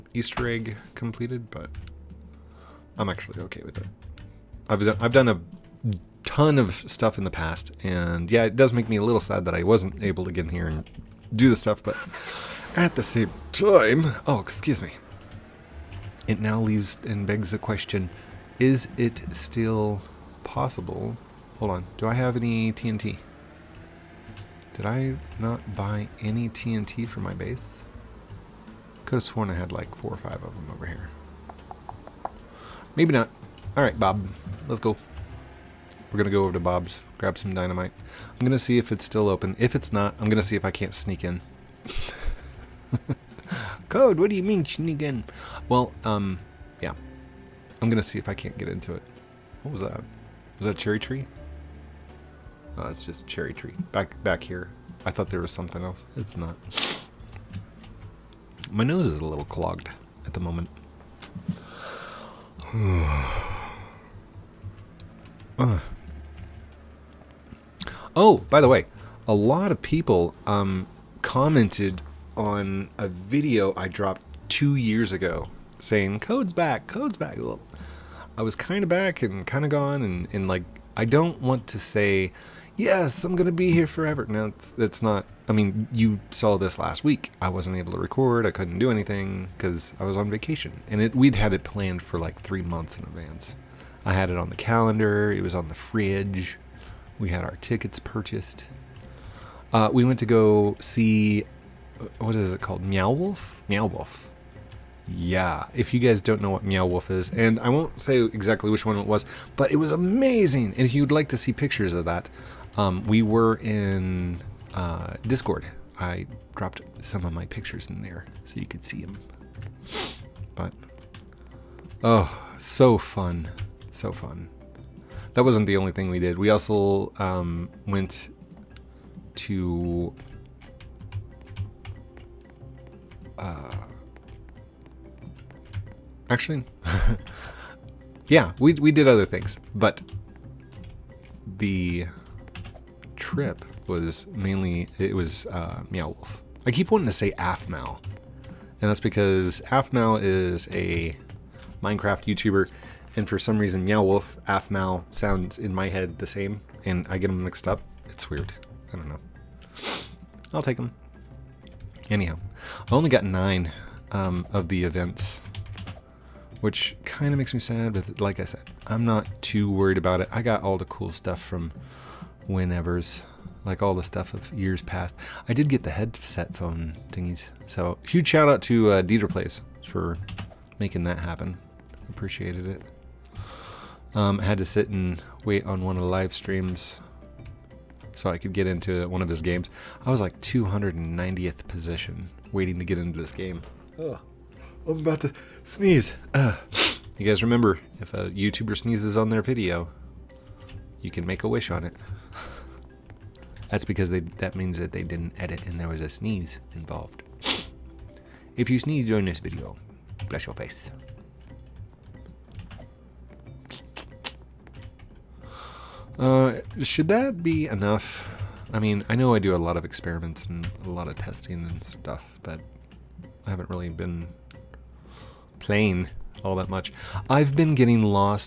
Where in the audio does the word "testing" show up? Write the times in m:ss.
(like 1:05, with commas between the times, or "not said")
3:41.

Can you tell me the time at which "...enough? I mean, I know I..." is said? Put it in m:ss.
3:37.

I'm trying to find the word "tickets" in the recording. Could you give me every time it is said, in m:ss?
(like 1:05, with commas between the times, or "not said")
1:37.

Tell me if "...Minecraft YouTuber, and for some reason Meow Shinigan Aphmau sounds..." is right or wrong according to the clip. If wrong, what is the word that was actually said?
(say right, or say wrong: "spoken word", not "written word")
wrong: "Wolf", not "Shinigan".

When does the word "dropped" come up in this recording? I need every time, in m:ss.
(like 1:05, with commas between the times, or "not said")
1:13, 1:56.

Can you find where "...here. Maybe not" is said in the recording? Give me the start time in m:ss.
0:30.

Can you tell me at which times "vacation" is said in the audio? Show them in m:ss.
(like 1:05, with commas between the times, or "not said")
1:30.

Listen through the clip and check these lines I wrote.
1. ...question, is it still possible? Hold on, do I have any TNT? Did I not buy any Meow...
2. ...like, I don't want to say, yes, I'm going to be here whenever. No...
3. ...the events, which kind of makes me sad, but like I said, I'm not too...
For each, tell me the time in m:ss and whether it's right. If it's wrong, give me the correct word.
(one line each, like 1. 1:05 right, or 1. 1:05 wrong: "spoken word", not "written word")
1. 0:17 wrong: "TNT", not "Meow"
2. 1:20 wrong: "forever", not "whenever"
3. 2:44 right.